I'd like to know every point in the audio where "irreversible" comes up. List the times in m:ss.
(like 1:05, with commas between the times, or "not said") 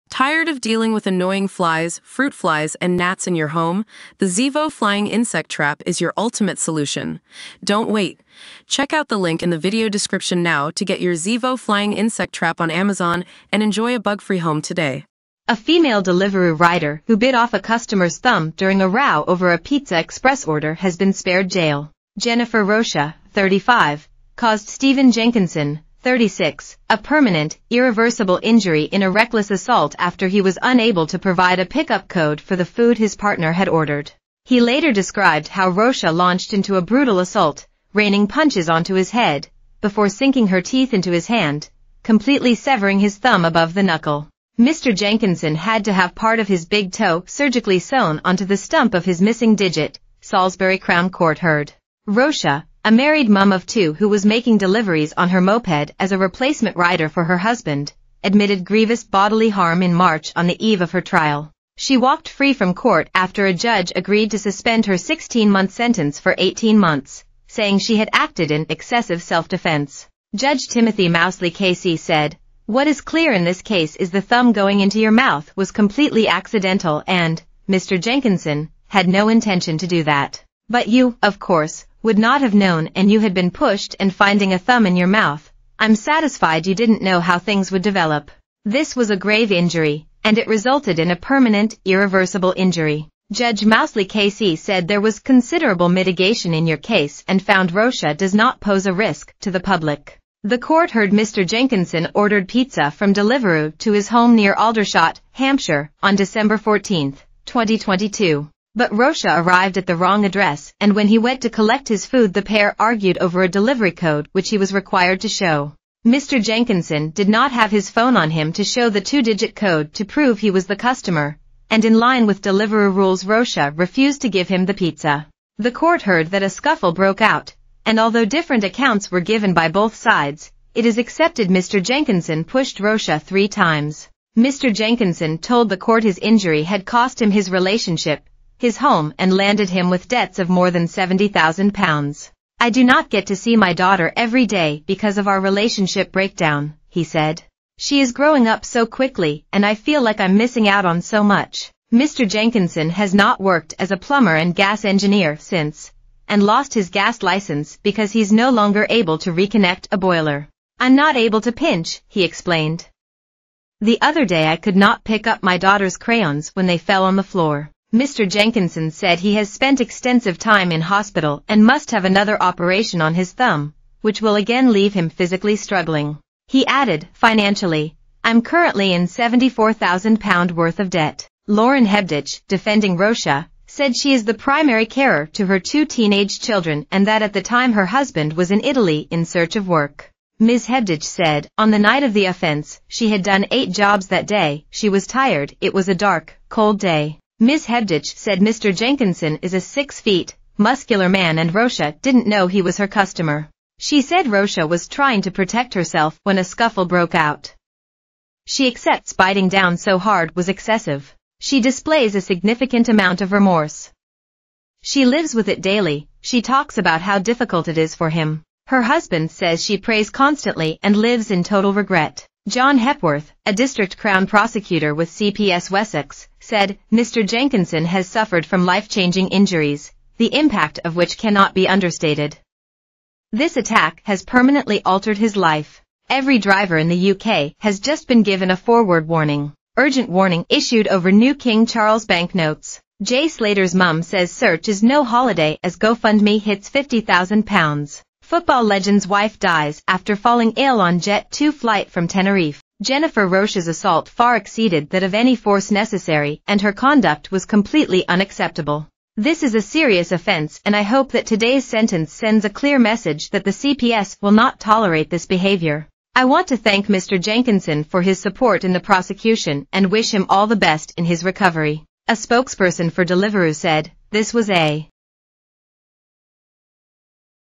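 0:27, 1:31.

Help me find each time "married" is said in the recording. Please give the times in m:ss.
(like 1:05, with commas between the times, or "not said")
0:52.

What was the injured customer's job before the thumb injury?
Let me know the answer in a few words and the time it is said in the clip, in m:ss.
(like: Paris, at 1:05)
Plumber and gas engineer, at 2:33.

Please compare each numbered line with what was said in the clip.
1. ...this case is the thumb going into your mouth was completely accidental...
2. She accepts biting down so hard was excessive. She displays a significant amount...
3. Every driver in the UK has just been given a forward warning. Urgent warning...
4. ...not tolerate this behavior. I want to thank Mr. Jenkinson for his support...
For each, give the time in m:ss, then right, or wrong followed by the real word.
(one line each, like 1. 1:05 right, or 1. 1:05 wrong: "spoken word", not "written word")
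1. 1:13 right
2. 3:28 right
3. 3:56 right
4. 4:24 right.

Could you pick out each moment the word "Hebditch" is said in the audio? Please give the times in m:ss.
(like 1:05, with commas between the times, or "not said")
3:01, 3:10, 3:17.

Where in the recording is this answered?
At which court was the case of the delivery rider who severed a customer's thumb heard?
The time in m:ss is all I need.
0:50.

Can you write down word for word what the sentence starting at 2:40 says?
I'm not able to pinch, he explained.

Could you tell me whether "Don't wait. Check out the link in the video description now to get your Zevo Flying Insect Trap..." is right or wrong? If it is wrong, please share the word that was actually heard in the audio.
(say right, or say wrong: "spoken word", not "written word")
right.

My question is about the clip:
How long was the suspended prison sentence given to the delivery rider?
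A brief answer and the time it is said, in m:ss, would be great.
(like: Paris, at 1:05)
16 months, at 1:04.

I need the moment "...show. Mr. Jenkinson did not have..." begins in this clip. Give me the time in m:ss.
1:55.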